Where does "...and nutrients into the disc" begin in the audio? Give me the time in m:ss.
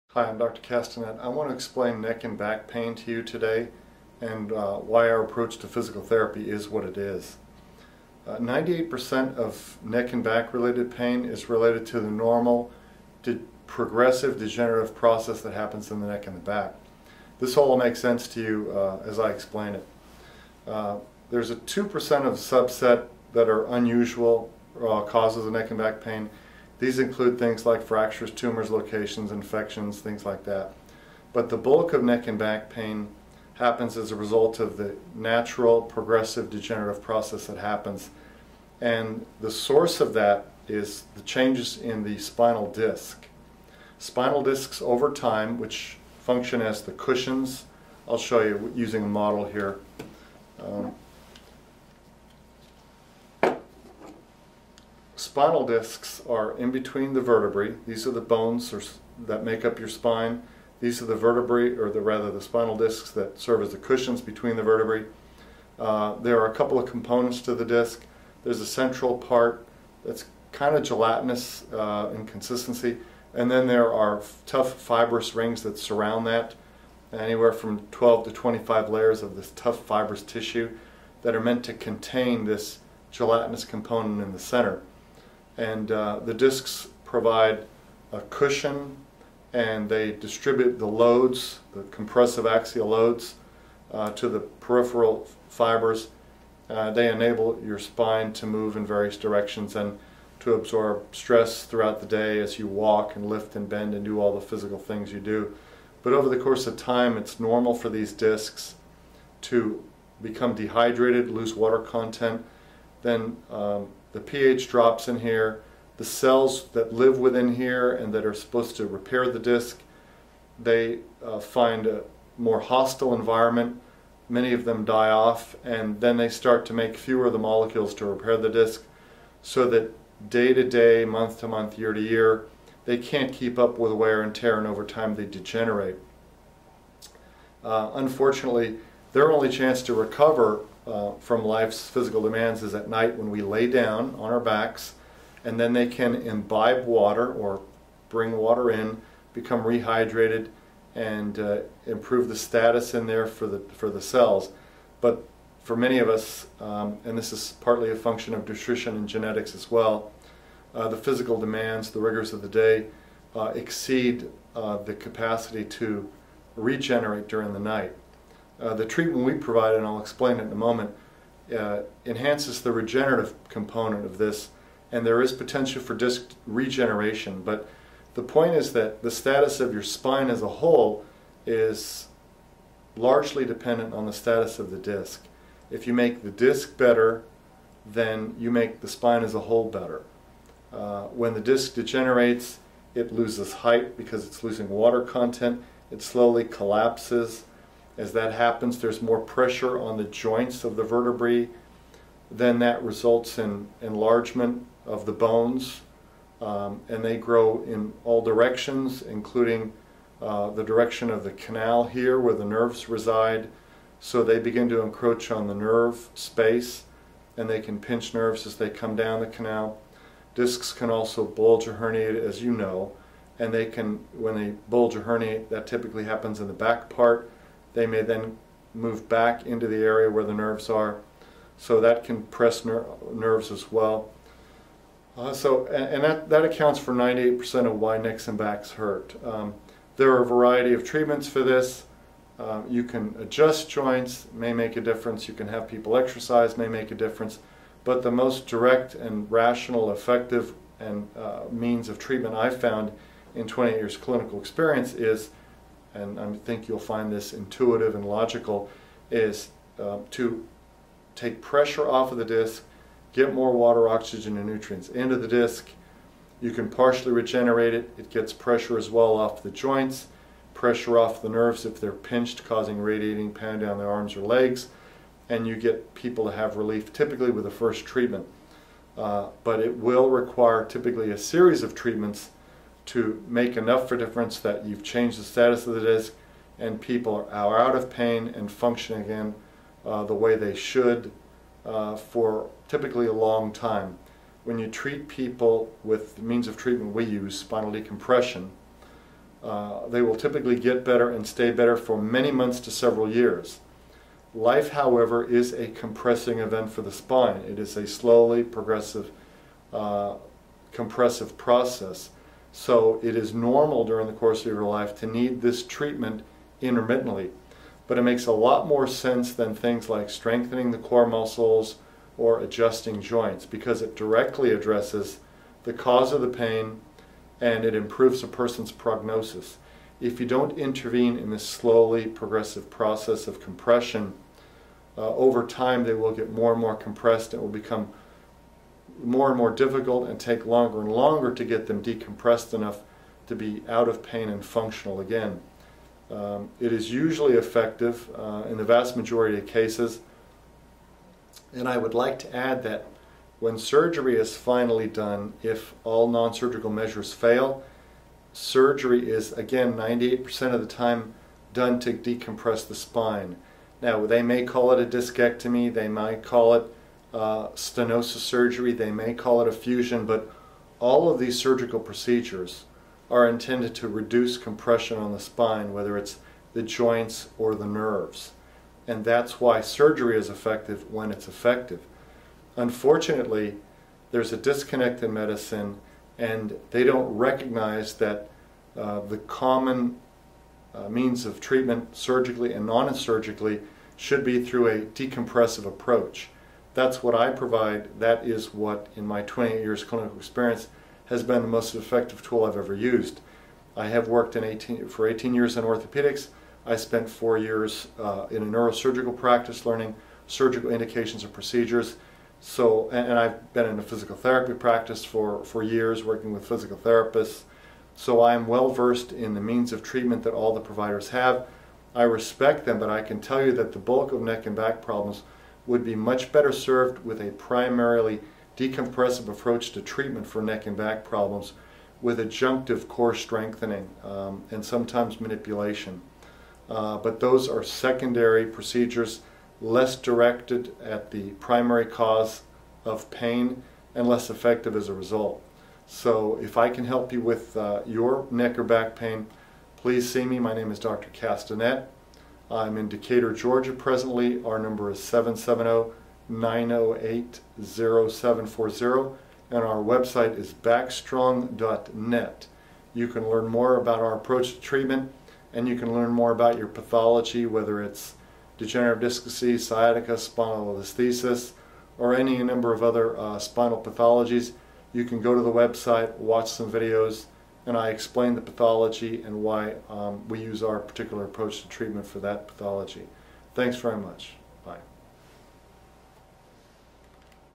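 4:24.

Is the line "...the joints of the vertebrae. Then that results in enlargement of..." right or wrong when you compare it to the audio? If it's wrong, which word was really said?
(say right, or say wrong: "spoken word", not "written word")
right.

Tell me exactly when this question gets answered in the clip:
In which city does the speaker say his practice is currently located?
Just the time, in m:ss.
7:32.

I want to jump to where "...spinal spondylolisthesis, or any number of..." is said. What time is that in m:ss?
7:50.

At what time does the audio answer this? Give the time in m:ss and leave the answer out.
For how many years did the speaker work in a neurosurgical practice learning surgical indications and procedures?
6:47.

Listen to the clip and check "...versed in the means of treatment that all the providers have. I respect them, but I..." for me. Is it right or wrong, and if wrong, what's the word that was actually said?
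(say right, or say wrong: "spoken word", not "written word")
right.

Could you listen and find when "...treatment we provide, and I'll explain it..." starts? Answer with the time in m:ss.
2:48.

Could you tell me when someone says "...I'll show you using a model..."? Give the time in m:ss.
0:48.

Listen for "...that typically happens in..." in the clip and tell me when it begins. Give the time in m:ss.
3:45.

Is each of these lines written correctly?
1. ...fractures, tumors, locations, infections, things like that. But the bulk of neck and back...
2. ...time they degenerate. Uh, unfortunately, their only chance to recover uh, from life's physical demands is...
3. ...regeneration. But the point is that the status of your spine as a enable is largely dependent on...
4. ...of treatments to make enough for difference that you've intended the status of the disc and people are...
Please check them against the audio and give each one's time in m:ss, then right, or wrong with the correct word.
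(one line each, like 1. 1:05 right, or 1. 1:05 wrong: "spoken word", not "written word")
1. 0:27 right
2. 2:14 right
3. 2:56 wrong: "whole", not "enable"
4. 4:41 wrong: "changed", not "intended".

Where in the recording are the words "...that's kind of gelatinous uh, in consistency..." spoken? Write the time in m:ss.
1:10.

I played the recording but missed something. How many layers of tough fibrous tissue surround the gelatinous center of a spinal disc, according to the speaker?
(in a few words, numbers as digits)
12 to 25.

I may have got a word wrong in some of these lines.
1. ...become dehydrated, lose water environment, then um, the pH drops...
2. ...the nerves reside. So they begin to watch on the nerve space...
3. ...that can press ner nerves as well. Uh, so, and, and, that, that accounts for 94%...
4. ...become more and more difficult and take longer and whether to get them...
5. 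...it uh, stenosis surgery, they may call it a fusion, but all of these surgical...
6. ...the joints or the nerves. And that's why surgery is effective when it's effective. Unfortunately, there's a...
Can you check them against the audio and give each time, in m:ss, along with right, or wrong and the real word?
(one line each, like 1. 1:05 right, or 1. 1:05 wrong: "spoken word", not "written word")
1. 1:50 wrong: "content", not "environment"
2. 3:32 wrong: "encroach", not "watch"
3. 3:51 wrong: "98", not "94"
4. 5:37 wrong: "longer", not "whether"
5. 6:06 right
6. 6:16 right.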